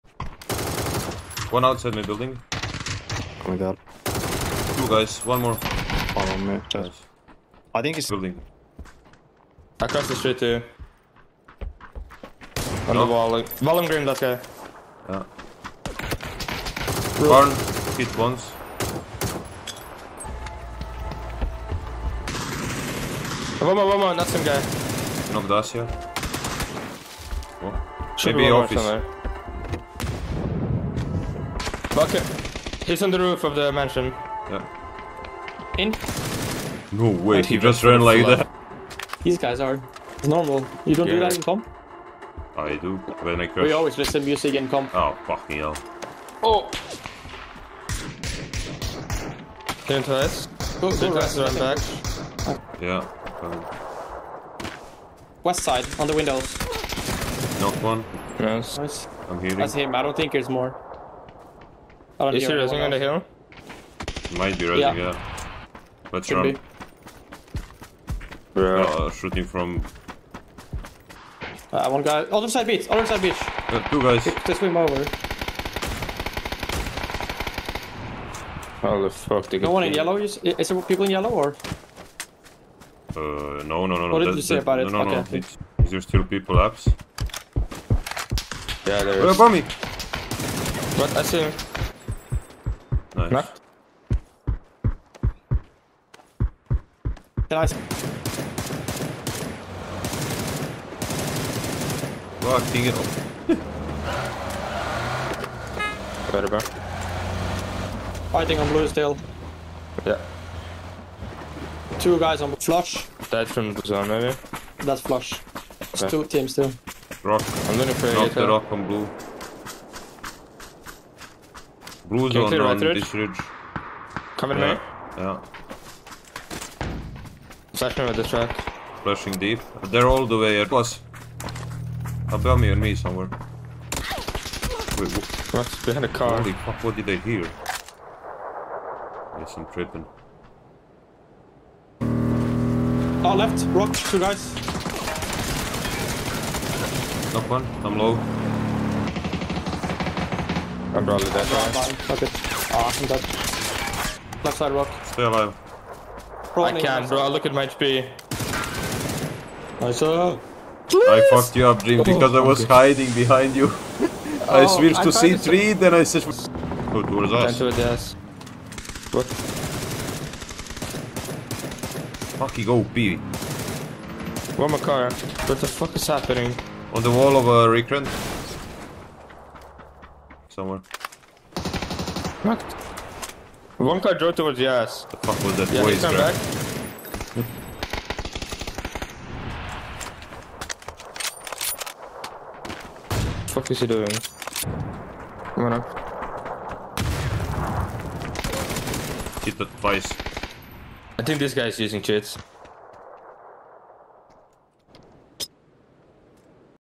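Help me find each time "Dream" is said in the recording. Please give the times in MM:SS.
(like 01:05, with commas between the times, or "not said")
02:41.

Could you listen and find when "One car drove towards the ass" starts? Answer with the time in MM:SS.
03:03.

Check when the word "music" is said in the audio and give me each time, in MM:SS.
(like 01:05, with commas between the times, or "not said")
00:44.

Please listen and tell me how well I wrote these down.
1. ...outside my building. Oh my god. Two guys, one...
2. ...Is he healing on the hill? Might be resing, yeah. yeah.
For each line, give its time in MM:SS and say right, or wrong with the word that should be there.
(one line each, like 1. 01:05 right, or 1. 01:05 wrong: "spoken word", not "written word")
1. 00:01 right
2. 01:02 wrong: "resing", not "healing".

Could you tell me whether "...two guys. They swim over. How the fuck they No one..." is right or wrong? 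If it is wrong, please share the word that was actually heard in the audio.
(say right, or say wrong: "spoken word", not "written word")
right.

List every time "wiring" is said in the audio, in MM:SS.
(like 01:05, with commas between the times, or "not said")
not said.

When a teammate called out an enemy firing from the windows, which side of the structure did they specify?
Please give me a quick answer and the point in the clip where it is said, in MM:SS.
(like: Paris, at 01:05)
West side, at 00:55.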